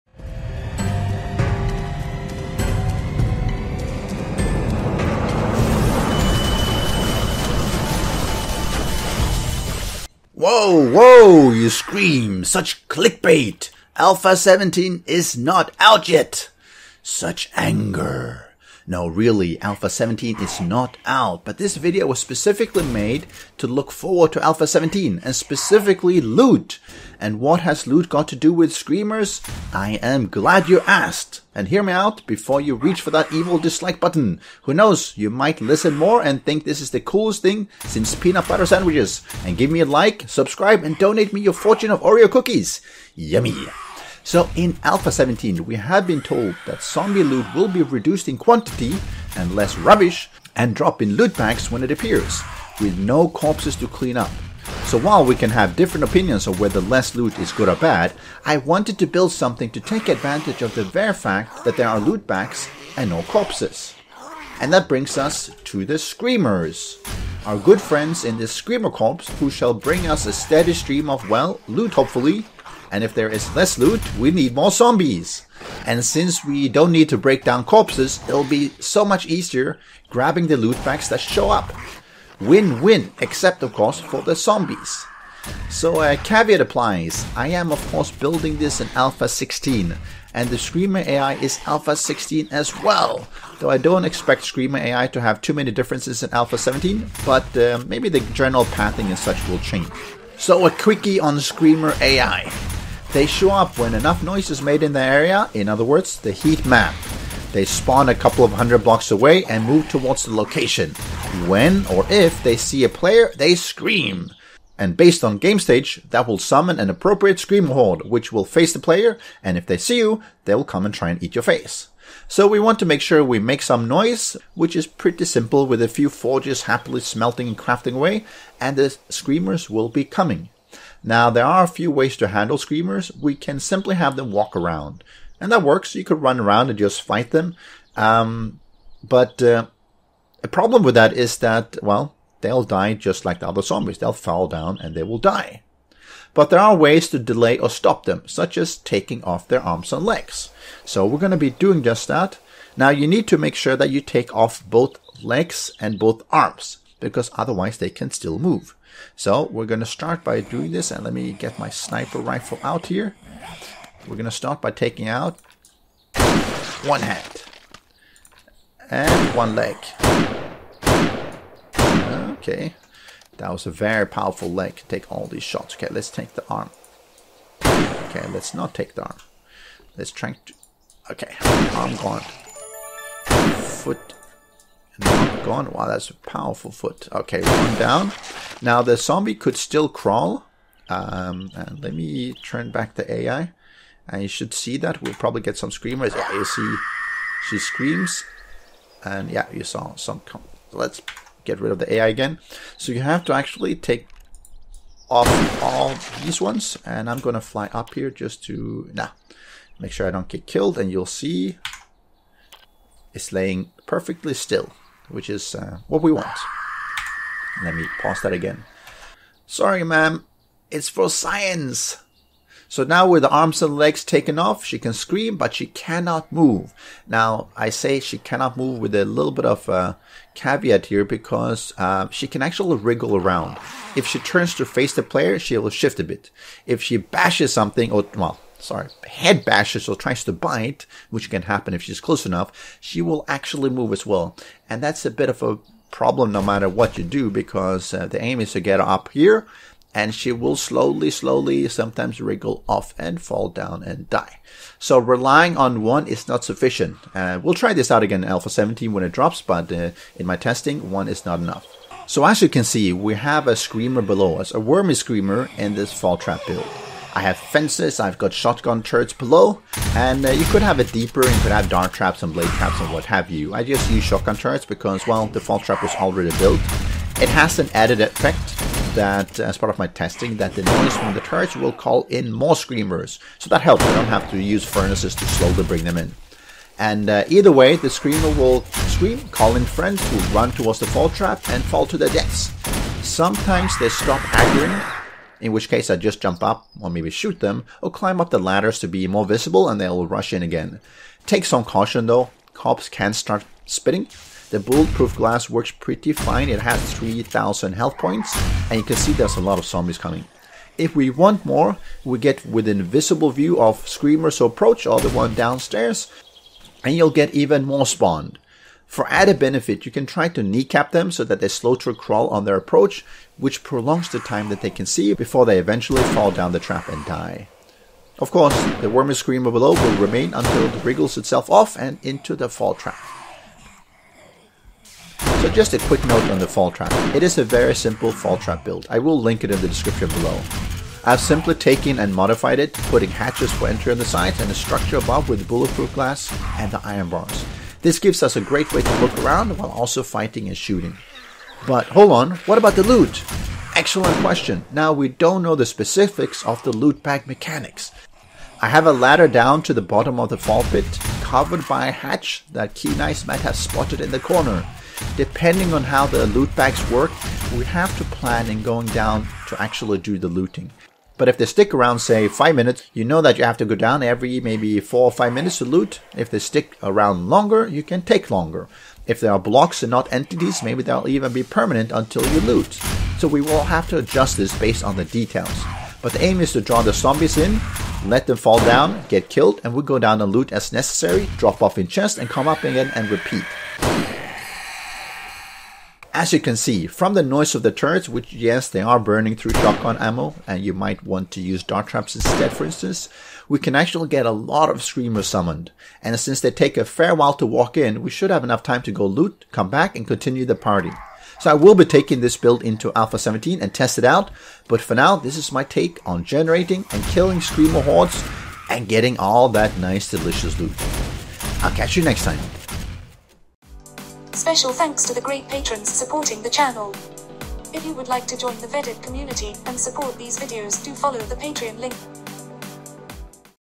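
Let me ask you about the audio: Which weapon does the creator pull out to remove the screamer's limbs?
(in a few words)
sniper rifle.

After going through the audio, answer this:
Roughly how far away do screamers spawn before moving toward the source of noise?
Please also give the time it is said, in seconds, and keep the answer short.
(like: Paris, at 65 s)
a couple of hundred blocks, at 108 s.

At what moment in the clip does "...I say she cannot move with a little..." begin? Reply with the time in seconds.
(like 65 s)
227 s.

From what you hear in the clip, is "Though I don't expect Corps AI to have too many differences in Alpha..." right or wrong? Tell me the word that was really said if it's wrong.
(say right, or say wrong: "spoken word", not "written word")
wrong: "Screamer", not "Corps".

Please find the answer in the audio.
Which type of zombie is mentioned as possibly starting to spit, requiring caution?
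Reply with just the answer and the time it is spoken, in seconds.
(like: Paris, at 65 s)
cops, at 302 s.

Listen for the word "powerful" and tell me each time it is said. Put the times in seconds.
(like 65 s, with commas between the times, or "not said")
174 s, 186 s.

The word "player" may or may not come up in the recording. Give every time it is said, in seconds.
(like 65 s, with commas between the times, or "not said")
112 s, 118 s, 235 s.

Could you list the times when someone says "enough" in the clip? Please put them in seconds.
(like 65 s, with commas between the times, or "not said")
103 s, 242 s, 261 s, 408 s.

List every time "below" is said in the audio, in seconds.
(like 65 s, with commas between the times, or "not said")
264 s, 269 s, 329 s, 340 s.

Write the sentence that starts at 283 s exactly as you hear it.
So that helps, I don't have to use furnaces to slowly bring them in.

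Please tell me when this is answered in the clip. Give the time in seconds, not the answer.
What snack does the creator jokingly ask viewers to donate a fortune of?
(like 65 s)
42 s.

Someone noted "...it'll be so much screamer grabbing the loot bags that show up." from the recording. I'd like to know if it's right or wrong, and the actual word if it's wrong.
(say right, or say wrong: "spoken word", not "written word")
wrong: "easier", not "screamer".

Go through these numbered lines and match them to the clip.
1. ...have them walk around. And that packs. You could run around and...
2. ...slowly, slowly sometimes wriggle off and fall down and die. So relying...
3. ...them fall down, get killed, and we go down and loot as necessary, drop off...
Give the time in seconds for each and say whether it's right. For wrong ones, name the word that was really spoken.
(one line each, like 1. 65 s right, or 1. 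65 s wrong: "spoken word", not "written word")
1. 133 s wrong: "works", not "packs"
2. 250 s right
3. 388 s right.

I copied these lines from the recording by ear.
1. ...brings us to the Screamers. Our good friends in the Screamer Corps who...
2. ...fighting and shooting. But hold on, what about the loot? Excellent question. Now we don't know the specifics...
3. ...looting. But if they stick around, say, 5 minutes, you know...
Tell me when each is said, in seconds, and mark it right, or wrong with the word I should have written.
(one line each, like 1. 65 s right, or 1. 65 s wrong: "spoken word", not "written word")
1. 64 s right
2. 350 s right
3. 370 s right.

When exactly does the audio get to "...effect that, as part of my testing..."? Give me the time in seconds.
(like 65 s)
277 s.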